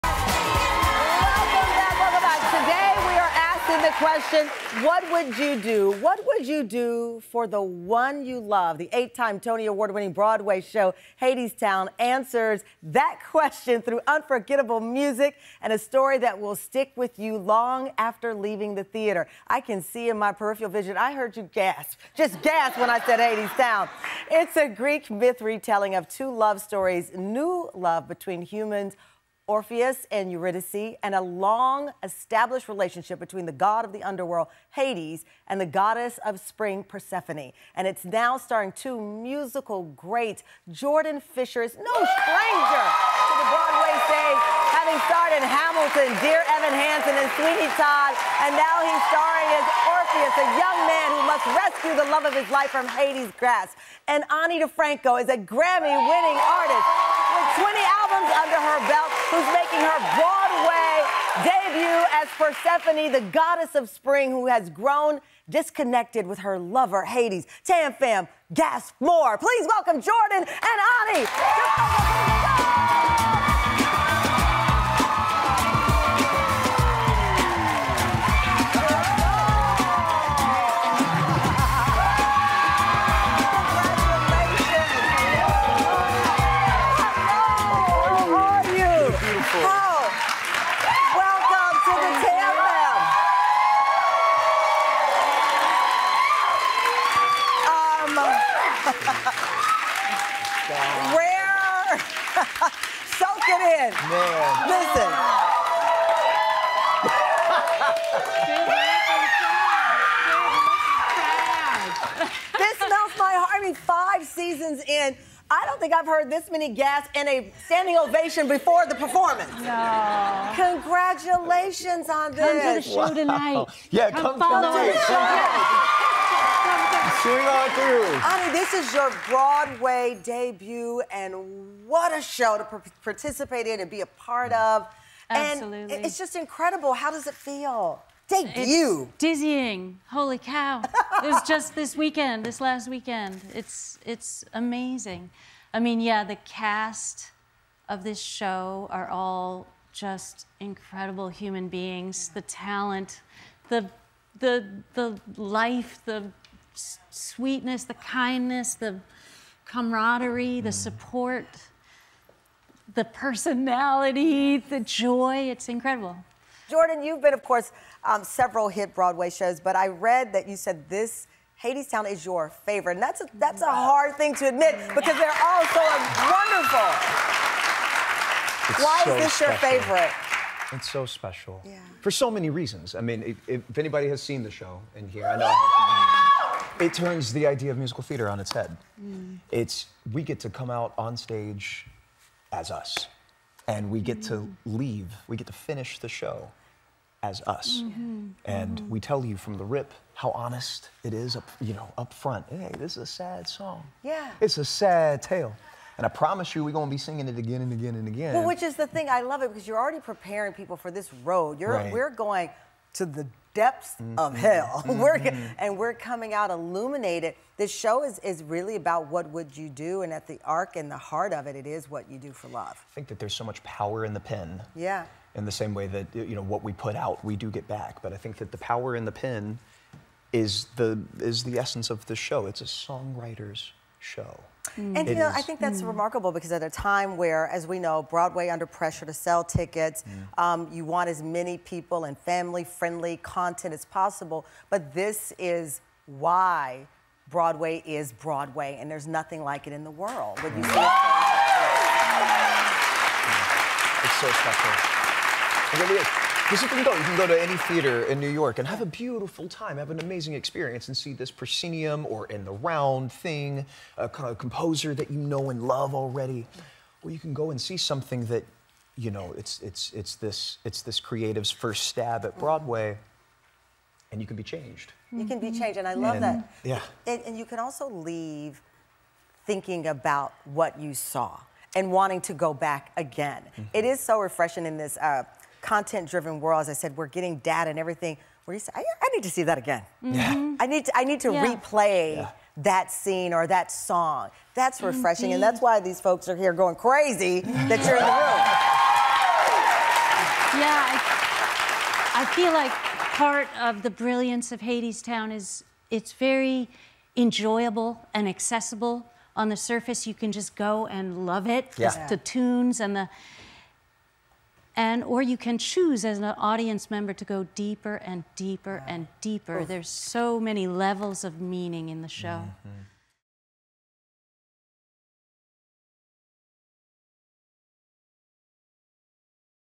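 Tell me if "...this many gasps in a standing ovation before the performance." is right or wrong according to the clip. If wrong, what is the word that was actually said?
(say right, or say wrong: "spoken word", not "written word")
right.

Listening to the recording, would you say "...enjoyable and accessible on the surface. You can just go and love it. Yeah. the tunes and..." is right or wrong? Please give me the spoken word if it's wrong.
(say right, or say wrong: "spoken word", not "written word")
right.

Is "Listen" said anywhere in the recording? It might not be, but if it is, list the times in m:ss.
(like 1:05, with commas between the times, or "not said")
1:44.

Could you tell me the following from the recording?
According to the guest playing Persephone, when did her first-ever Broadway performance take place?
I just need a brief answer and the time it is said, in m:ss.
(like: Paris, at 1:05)
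last weekend, at 2:22.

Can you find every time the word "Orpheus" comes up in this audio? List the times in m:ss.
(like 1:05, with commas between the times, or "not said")
0:29, 0:49.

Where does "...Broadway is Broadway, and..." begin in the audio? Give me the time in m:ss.
4:07.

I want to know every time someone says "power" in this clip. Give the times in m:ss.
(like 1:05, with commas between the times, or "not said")
3:43, 3:48.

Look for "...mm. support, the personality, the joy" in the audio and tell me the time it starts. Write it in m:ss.
2:40.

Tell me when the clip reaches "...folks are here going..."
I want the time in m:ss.
4:56.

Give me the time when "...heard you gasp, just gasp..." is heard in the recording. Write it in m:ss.
0:21.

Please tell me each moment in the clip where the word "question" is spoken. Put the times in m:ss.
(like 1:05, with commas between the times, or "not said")
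0:03, 0:13.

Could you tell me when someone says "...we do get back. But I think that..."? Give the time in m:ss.
3:47.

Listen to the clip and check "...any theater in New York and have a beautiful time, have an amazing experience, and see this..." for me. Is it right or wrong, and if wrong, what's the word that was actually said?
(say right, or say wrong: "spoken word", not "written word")
right.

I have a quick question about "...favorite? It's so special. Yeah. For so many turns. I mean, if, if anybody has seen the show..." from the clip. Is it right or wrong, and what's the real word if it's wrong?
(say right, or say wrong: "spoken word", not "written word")
wrong: "reasons", not "turns".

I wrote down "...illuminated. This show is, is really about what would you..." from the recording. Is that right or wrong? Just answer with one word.
right.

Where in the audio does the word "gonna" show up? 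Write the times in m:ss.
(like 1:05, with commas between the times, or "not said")
3:26.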